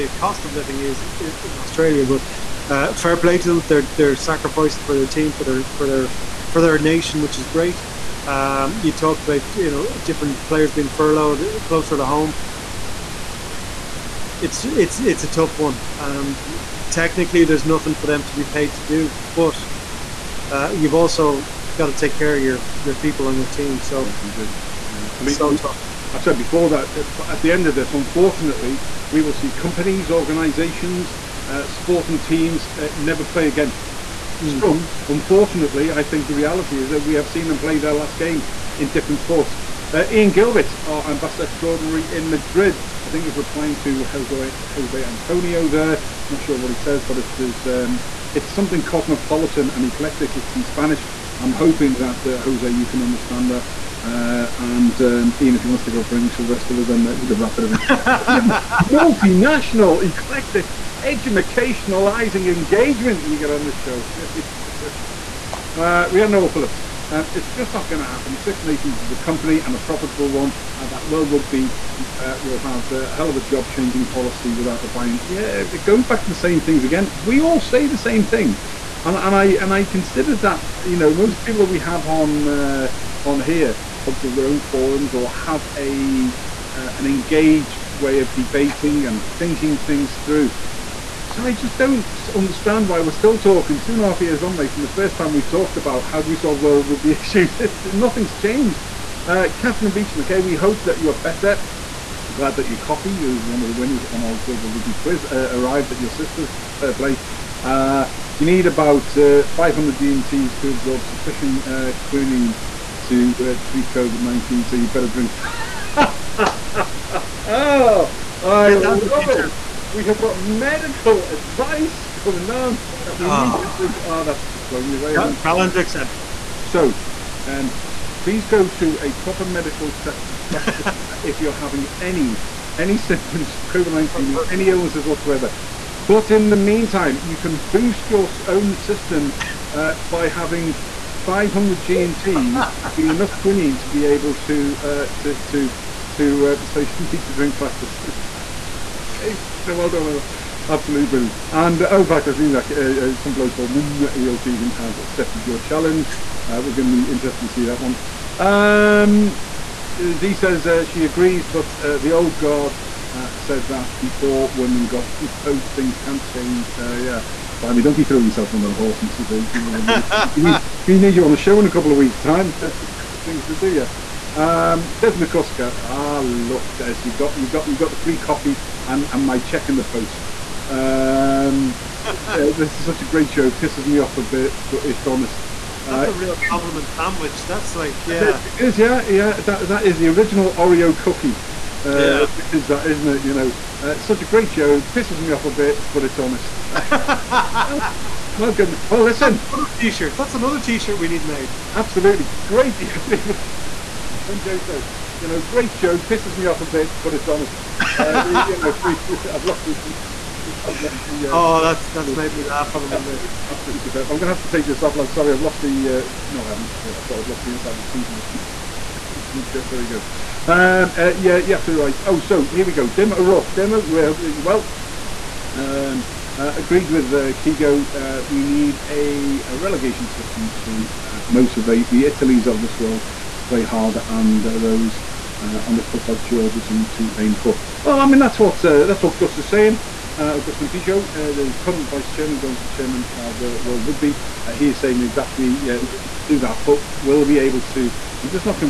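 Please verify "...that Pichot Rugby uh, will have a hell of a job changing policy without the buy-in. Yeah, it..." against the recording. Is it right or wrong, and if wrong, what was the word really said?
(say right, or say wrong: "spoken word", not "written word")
wrong: "World", not "Pichot".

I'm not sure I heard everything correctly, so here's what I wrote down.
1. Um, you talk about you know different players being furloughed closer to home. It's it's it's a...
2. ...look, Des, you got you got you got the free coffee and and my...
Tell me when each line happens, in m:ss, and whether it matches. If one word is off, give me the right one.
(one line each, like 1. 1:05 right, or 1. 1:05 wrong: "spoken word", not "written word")
1. 0:08 right
2. 2:56 right.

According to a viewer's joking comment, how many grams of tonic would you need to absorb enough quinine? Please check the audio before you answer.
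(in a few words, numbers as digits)
500 g.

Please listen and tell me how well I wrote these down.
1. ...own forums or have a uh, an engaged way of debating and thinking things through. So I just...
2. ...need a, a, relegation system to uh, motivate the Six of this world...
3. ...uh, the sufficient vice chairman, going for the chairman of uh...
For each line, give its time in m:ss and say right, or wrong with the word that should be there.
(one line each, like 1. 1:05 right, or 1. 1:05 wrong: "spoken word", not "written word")
1. 1:24 right
2. 3:48 wrong: "Italies", not "Six"
3. 4:01 wrong: "current", not "sufficient".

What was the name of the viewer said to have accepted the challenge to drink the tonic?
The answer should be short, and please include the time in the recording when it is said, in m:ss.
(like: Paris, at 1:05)
Neil Keegan, at 2:33.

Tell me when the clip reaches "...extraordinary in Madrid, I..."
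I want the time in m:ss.
0:41.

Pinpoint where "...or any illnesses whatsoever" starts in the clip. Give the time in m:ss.
2:14.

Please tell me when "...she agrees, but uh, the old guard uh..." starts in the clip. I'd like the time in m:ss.
2:40.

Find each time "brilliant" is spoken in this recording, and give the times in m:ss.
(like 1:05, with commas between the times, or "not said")
2:31.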